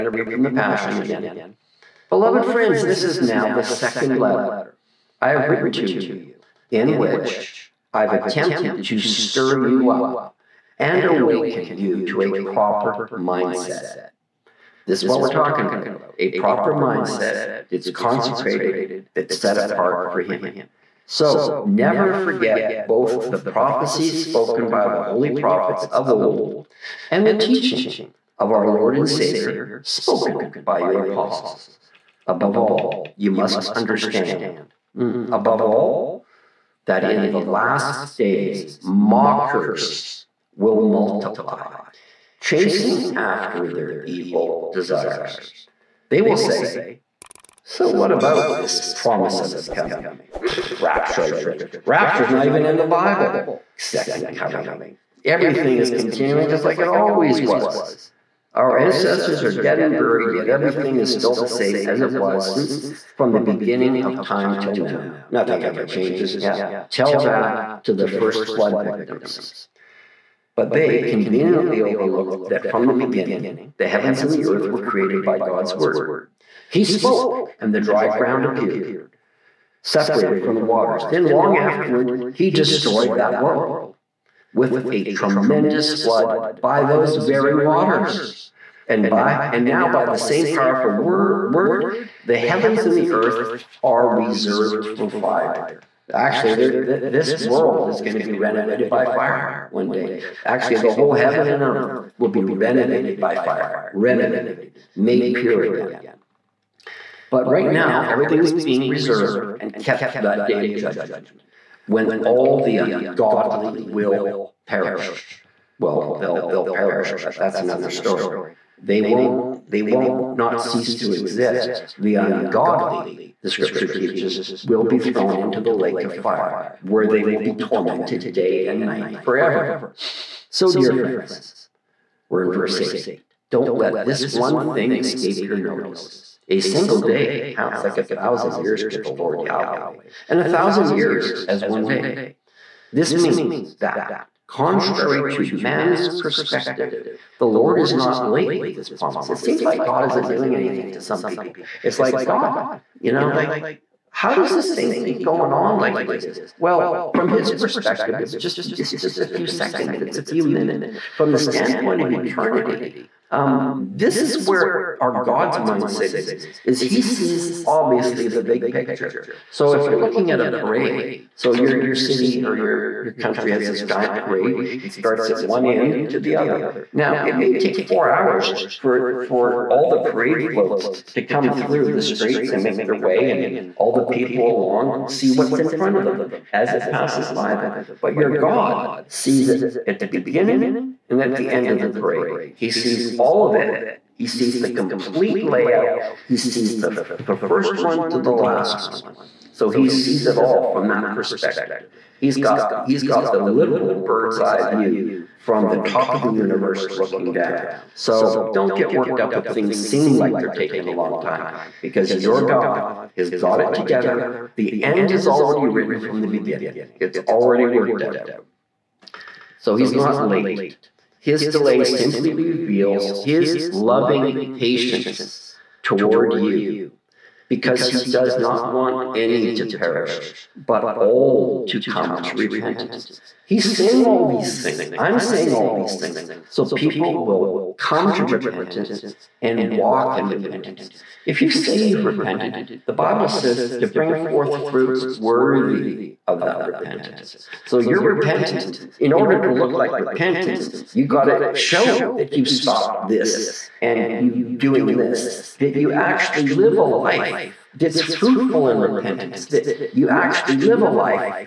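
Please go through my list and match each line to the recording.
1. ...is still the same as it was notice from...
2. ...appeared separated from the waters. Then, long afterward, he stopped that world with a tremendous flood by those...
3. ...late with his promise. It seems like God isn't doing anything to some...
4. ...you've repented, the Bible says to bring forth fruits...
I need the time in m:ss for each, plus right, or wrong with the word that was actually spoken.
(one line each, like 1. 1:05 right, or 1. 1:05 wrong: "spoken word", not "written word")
1. 1:00 wrong: "since", not "notice"
2. 1:18 wrong: "destroyed", not "stopped"
3. 2:28 right
4. 4:01 right.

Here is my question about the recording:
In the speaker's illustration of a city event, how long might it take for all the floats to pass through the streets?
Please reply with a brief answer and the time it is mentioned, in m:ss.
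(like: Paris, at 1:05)
4 hours, at 2:57.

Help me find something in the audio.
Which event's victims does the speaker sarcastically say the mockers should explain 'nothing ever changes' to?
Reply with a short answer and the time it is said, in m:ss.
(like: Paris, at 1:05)
the first flood, at 1:08.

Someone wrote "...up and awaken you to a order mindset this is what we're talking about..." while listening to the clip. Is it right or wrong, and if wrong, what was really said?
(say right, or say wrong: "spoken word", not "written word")
wrong: "proper", not "order".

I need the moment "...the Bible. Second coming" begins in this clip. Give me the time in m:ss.
0:52.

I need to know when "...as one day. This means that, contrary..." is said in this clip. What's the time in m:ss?
2:21.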